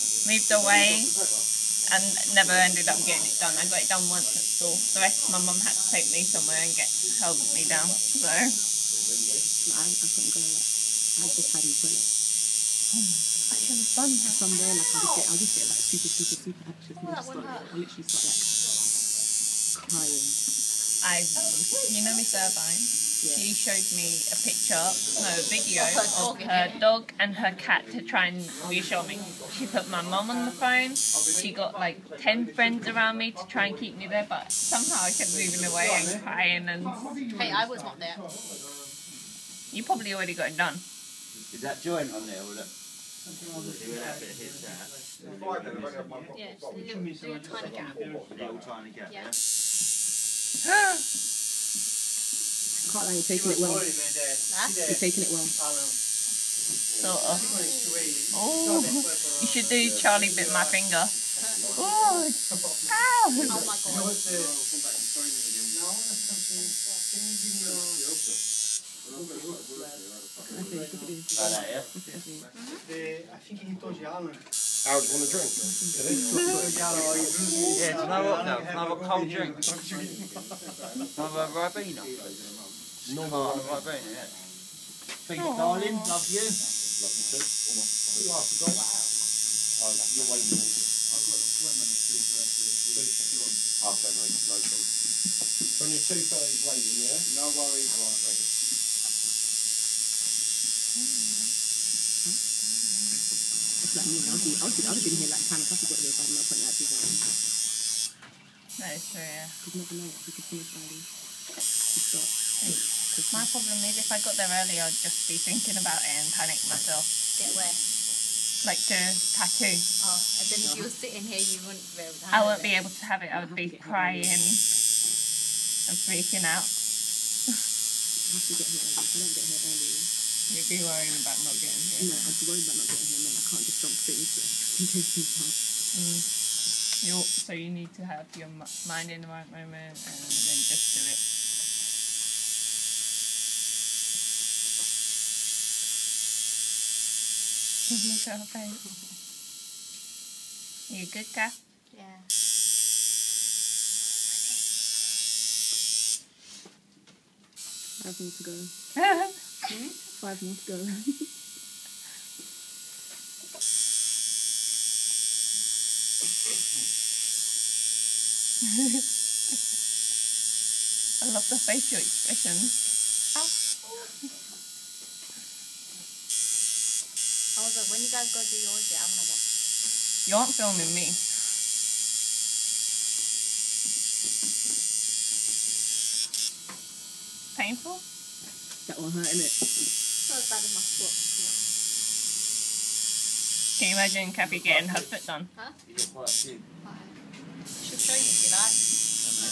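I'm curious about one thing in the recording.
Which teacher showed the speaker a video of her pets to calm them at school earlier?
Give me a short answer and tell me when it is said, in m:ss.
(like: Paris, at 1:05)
Miss Irvine, at 0:22.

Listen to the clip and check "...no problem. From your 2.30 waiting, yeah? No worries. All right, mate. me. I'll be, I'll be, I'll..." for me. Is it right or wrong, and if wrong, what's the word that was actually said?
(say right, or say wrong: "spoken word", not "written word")
right.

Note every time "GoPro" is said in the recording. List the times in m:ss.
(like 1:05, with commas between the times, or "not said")
not said.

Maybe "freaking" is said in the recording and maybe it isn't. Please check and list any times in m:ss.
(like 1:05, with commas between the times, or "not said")
2:06.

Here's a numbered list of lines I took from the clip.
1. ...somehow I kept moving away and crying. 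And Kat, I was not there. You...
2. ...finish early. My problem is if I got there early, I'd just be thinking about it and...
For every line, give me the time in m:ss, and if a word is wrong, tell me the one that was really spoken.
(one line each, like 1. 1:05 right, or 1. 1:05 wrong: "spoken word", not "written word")
1. 0:34 wrong: "Hey", not "Kat"
2. 1:50 right.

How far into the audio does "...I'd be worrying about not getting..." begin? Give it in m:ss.
2:12.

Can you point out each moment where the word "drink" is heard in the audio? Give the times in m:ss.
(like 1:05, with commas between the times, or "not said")
1:15, 1:19.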